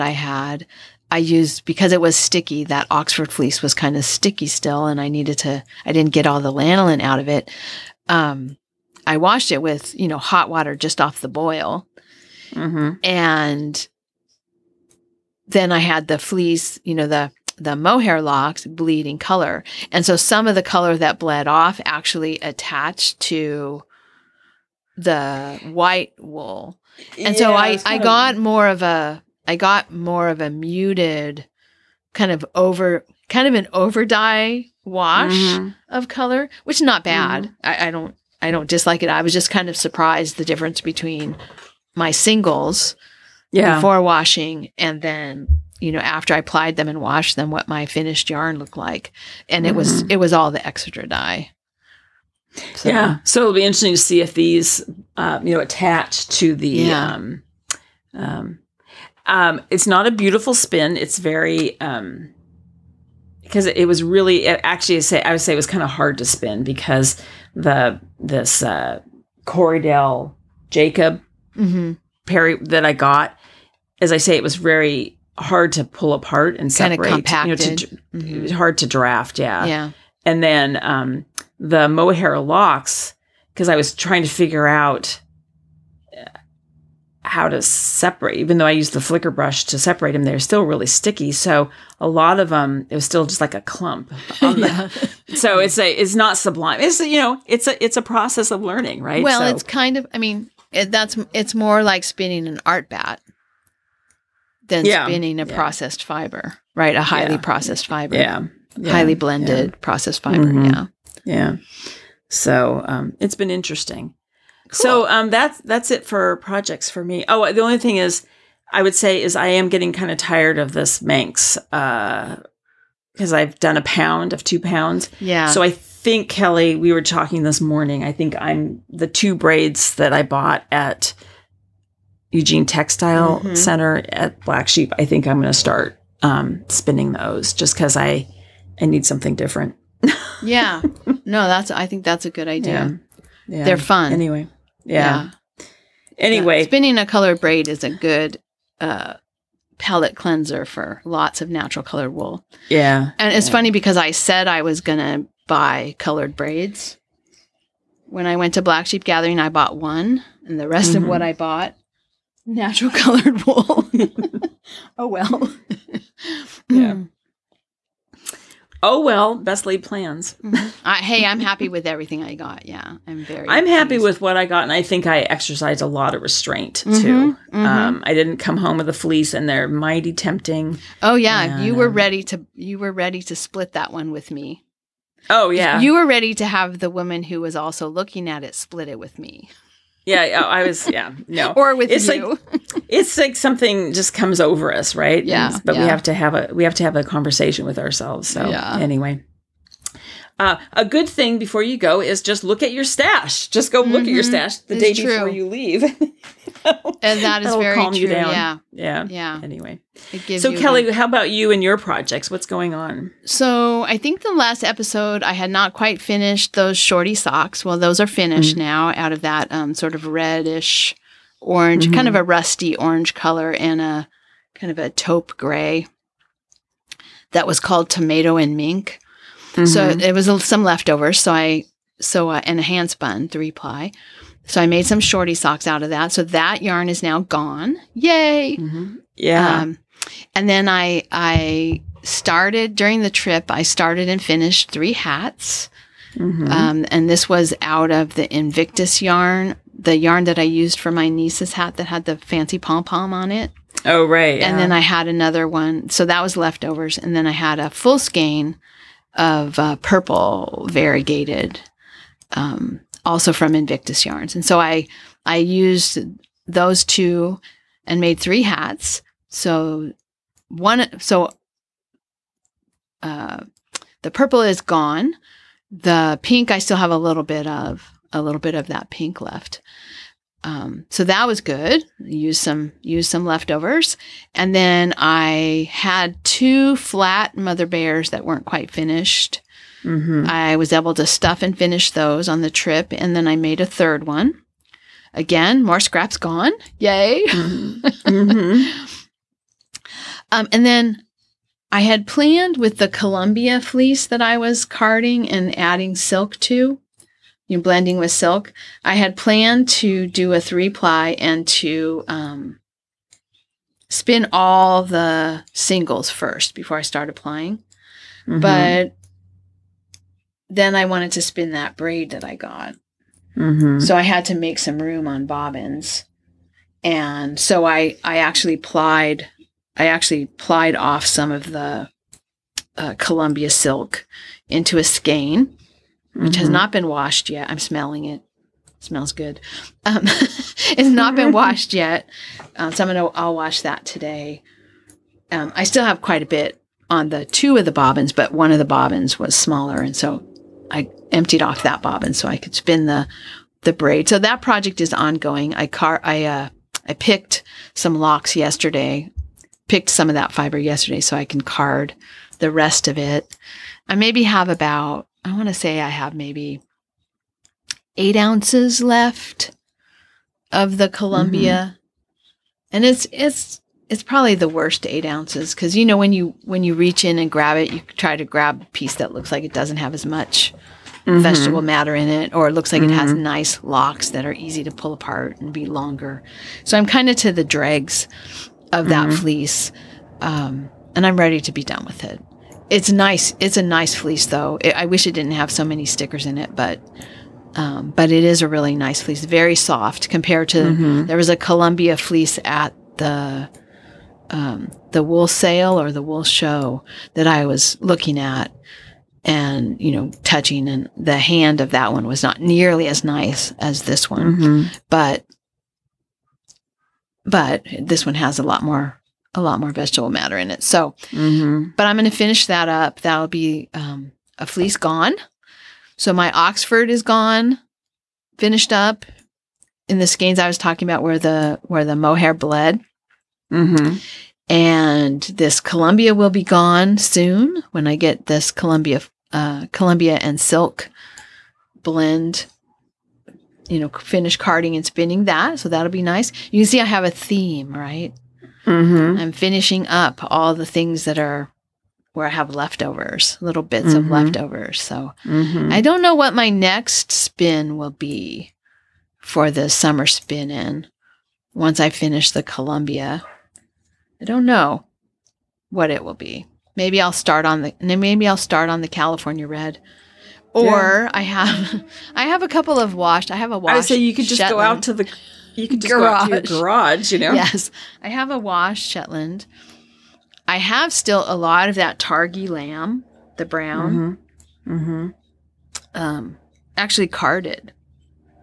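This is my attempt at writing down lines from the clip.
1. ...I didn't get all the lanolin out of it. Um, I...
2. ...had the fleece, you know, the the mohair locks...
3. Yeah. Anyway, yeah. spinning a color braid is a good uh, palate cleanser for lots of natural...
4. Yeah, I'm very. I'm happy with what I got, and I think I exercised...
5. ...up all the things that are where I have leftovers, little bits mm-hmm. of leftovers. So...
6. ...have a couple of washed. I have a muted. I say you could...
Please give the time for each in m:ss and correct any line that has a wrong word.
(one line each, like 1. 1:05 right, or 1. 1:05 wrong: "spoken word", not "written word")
1. 0:05 right
2. 0:15 right
3. 2:24 right
4. 2:52 right
5. 7:29 right
6. 7:52 wrong: "washed", not "muted".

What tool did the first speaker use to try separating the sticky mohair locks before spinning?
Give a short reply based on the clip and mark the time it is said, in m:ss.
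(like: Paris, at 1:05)
Flicker brush, at 1:29.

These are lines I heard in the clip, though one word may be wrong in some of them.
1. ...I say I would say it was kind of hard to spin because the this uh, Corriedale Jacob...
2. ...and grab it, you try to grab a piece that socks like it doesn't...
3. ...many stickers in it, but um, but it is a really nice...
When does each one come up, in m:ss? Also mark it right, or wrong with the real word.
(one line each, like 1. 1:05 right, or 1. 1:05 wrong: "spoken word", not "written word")
1. 1:04 right
2. 6:17 wrong: "looks", not "socks"
3. 6:35 right.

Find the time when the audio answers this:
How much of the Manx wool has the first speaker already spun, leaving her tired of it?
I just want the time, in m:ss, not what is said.
2:04.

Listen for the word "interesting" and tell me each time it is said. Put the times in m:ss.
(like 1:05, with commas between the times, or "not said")
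0:53, 1:53.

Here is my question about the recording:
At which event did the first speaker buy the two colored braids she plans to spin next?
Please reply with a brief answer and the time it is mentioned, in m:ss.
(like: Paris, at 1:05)
Black Sheep Gathering, at 2:38.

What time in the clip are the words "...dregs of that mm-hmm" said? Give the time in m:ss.
6:27.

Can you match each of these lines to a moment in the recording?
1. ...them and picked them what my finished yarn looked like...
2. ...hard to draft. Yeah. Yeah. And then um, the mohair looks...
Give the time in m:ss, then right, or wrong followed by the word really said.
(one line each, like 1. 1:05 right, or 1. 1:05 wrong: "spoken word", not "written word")
1. 0:46 wrong: "washed", not "picked"
2. 1:18 wrong: "locks", not "looks".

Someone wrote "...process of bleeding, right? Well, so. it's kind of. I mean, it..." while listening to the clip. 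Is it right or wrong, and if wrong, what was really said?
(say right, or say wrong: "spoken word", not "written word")
wrong: "learning", not "bleeding".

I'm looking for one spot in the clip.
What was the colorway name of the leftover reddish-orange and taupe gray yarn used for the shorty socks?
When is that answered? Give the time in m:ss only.
3:47.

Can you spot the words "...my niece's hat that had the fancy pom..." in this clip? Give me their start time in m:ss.
4:10.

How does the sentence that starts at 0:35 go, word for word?
of color, which is not bad.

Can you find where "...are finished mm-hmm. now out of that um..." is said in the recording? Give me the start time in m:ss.
3:38.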